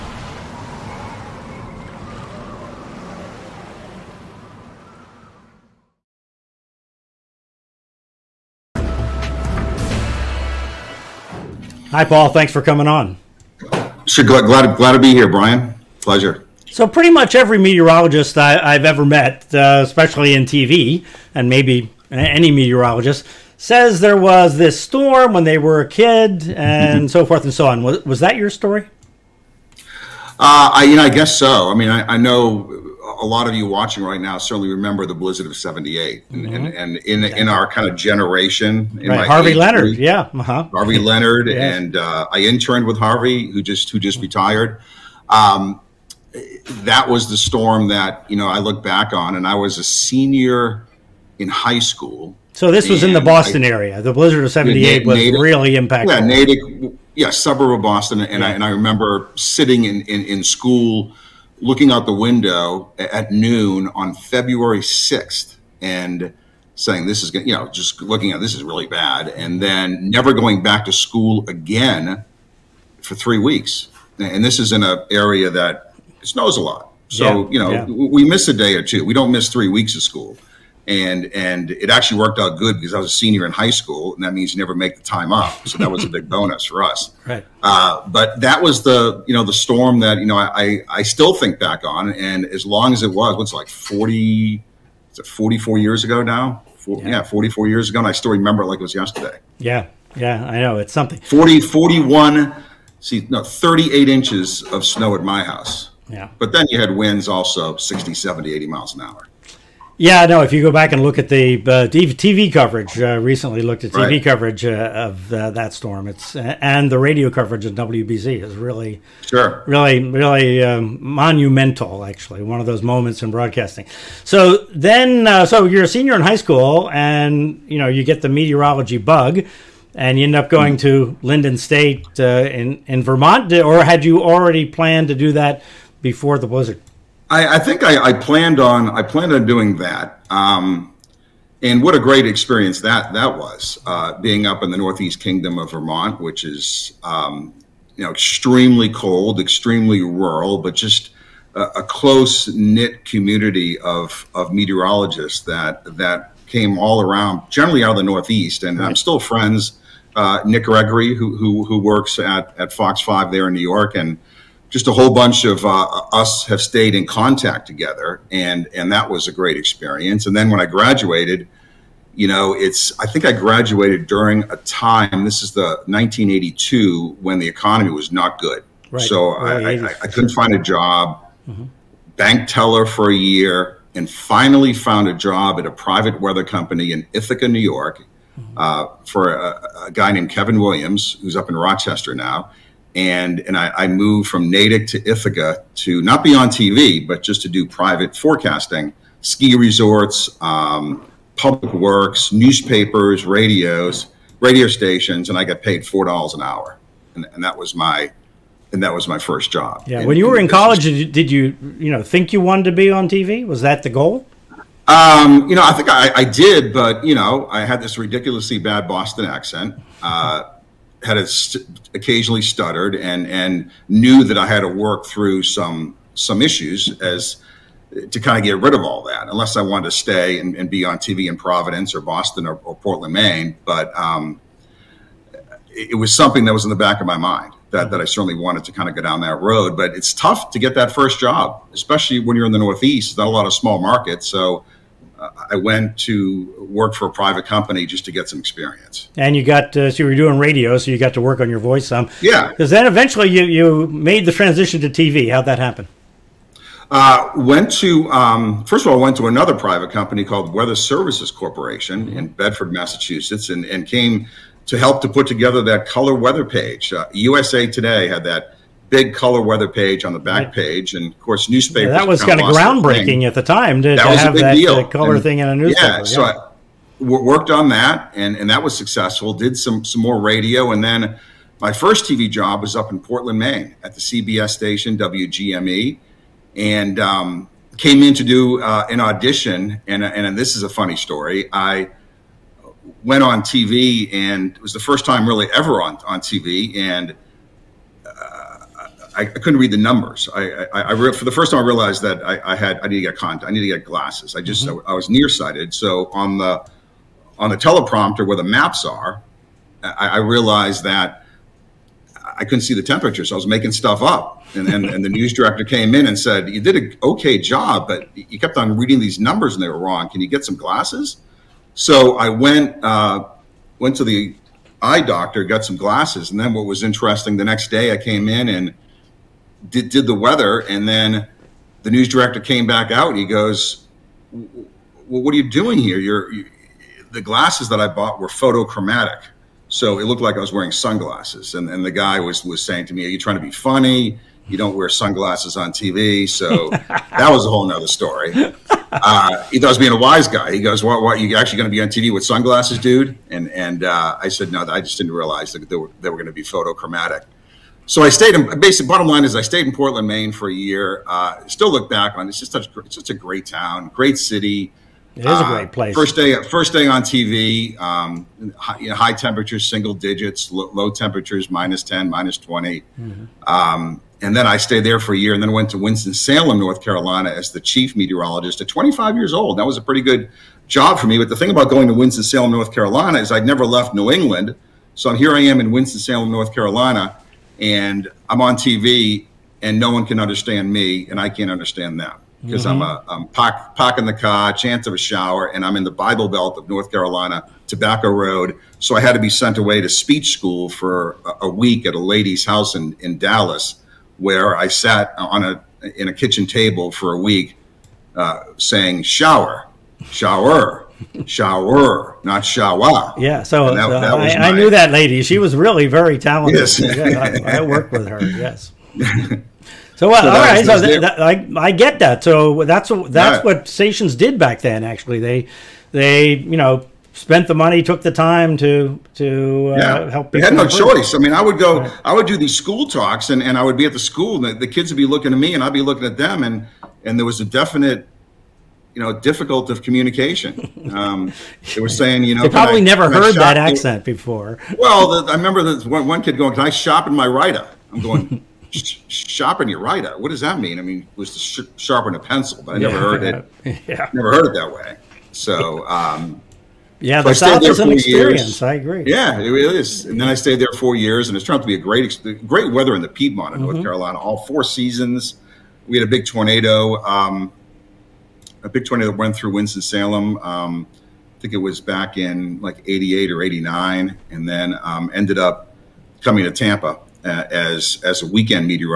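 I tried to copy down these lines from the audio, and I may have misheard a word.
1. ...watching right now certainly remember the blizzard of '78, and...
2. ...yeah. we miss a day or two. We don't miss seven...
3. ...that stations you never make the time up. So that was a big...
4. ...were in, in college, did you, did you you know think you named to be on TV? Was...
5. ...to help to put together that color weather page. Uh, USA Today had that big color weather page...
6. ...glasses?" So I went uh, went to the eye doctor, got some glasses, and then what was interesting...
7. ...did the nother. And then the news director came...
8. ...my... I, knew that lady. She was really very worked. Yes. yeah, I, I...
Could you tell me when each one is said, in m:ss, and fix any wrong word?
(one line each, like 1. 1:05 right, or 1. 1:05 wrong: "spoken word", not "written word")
1. 0:33 right
2. 1:17 wrong: "three", not "seven"
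3. 1:24 wrong: "means", not "stations"
4. 3:30 wrong: "wanted", not "named"
5. 4:24 right
6. 5:20 right
7. 5:29 wrong: "weather", not "nother"
8. 6:54 wrong: "talented", not "worked".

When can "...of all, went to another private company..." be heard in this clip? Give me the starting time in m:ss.
4:18.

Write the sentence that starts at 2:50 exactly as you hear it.
And then when I graduated, you know, it's I think I graduated during a time.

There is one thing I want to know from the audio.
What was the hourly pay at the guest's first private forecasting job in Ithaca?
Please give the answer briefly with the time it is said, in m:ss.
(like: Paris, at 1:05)
$4 an hour, at 3:25.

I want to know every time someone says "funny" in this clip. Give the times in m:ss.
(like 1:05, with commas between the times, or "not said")
4:50, 5:43.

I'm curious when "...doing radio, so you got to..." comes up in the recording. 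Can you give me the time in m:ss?
4:10.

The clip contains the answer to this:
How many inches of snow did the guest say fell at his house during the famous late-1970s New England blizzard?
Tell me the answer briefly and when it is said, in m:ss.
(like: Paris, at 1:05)
38, at 1:43.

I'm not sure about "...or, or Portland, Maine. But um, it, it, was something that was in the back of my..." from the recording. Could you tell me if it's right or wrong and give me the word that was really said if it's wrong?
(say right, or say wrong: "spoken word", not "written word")
right.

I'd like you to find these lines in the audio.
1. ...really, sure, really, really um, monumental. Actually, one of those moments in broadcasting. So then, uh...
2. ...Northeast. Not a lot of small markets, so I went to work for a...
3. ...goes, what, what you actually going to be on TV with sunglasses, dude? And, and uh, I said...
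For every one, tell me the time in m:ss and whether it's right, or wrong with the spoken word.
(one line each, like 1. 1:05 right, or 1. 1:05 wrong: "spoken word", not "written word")
1. 1:58 right
2. 4:02 right
3. 5:50 right.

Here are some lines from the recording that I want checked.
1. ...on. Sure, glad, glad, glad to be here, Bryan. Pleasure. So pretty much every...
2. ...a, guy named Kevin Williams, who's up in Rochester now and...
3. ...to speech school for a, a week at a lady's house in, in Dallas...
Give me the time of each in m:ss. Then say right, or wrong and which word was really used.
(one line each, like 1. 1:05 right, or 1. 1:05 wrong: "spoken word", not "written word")
1. 0:12 right
2. 3:09 right
3. 6:39 right.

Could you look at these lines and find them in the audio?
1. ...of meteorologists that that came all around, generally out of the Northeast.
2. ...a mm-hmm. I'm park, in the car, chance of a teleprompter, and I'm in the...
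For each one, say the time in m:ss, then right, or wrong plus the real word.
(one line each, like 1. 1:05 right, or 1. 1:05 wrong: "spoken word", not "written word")
1. 2:34 right
2. 6:32 wrong: "shower", not "teleprompter".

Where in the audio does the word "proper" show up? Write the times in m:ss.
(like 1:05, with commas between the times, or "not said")
not said.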